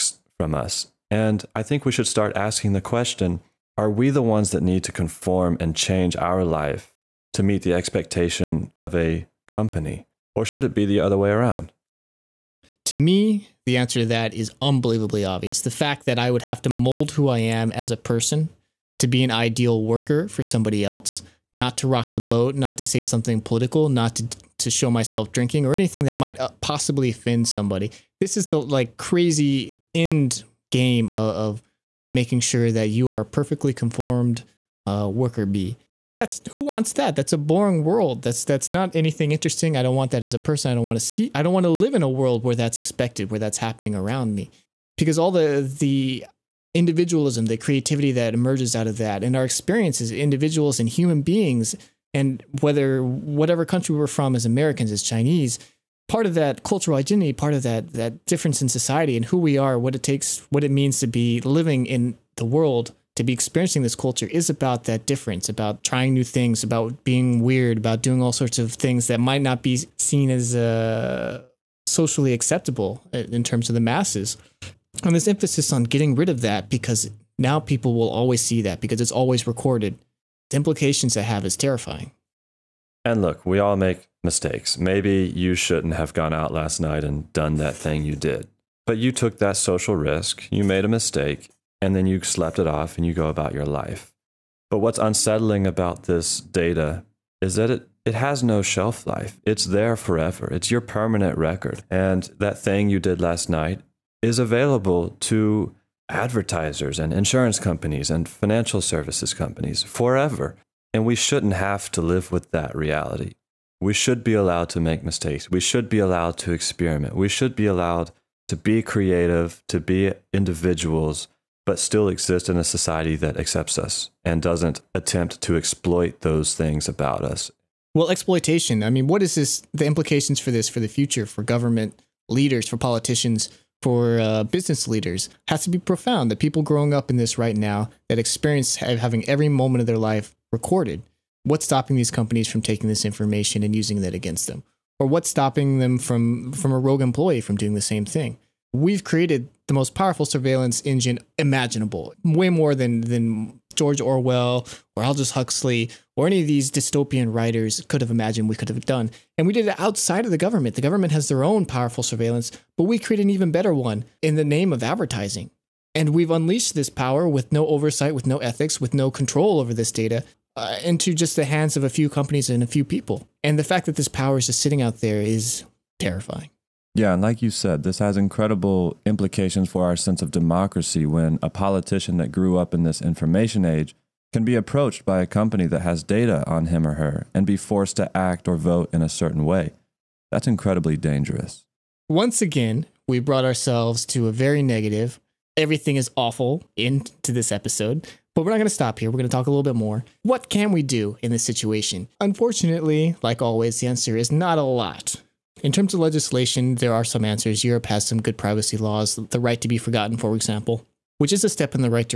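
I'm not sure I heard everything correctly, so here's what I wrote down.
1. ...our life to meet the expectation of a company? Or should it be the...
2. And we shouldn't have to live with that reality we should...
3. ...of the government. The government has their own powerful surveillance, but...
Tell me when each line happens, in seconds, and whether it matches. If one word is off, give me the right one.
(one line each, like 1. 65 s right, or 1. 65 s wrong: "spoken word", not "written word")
1. 6 s right
2. 110 s right
3. 160 s right.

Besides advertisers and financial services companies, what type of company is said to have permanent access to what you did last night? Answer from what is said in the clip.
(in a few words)
Insurance companies.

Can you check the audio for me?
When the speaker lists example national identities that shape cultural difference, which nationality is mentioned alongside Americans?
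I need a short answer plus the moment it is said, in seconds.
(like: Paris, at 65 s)
Chinese, at 55 s.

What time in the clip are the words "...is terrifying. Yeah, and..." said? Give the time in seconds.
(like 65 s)
175 s.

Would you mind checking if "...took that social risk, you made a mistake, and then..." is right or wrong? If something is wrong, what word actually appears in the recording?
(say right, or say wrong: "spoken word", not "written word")
right.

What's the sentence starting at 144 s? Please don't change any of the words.
Or what's stopping them from, from a rogue employee from doing the same thing?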